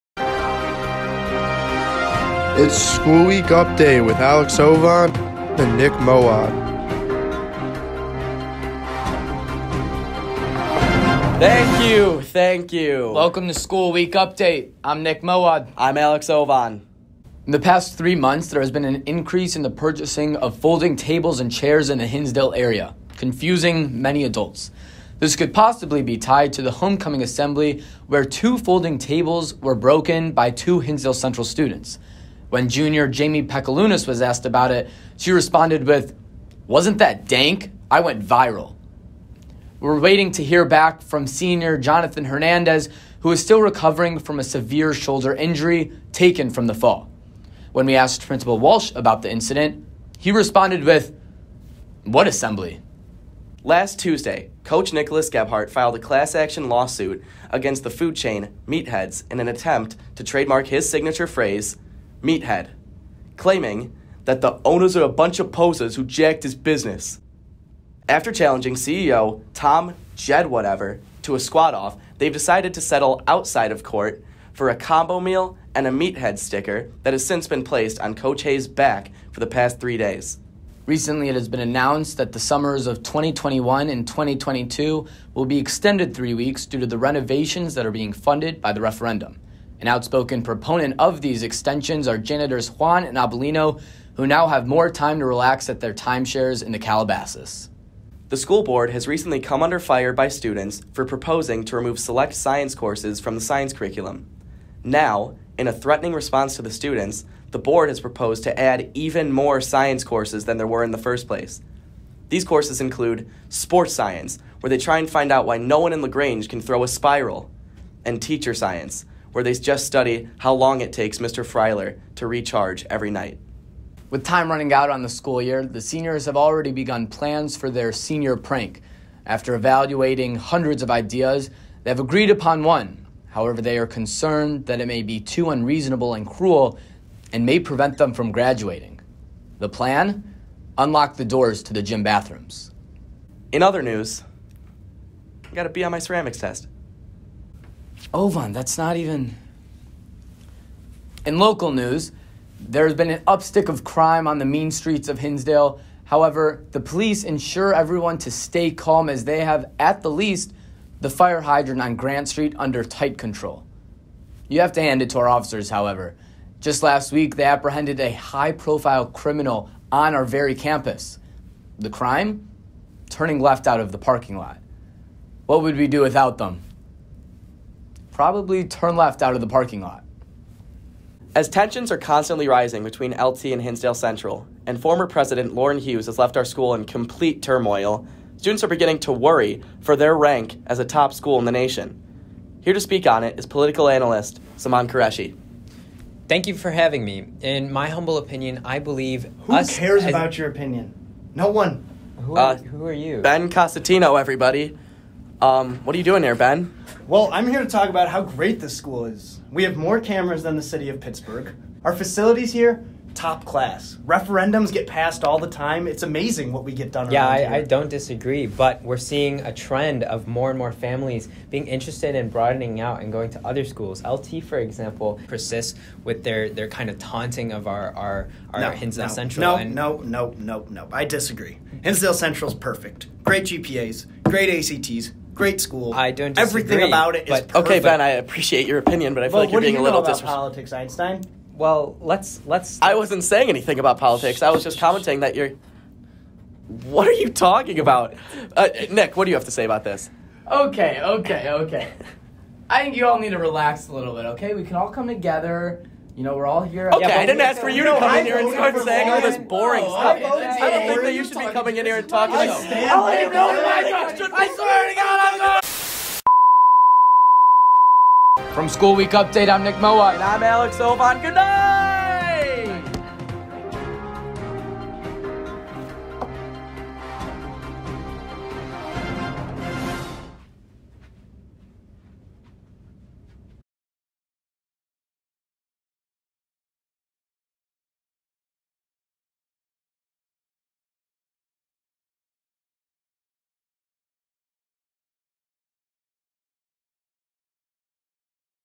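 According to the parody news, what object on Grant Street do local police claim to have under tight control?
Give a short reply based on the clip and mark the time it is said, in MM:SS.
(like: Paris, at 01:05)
fire hydrant, at 02:41.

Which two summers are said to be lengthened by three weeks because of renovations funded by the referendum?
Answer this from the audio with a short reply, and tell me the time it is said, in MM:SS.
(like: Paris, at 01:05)
2021 and 2022, at 01:23.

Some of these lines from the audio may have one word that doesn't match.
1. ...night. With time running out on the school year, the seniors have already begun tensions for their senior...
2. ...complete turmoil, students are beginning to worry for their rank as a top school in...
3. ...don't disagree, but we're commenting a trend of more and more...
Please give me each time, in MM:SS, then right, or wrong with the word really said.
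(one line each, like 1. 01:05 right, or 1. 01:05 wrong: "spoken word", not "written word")
1. 02:03 wrong: "plans", not "tensions"
2. 03:06 right
3. 03:37 wrong: "seeing", not "commenting".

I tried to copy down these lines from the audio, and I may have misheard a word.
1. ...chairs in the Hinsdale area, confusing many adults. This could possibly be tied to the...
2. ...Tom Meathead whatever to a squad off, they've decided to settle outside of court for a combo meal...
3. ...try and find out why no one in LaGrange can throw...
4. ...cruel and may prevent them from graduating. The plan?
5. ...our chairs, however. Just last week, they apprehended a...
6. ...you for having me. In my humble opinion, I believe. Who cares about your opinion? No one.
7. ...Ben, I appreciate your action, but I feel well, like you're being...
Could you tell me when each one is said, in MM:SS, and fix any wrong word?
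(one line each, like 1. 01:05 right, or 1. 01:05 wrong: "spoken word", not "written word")
1. 00:21 right
2. 01:09 wrong: "Jed", not "Meathead"
3. 01:54 right
4. 02:16 right
5. 02:45 wrong: "officers", not "chairs"
6. 03:16 right
7. 03:57 wrong: "opinion", not "action".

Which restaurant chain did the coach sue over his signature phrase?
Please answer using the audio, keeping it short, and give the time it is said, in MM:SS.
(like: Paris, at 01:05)
Meatheads, at 00:58.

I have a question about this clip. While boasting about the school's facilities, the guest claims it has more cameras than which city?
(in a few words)
Pittsburgh.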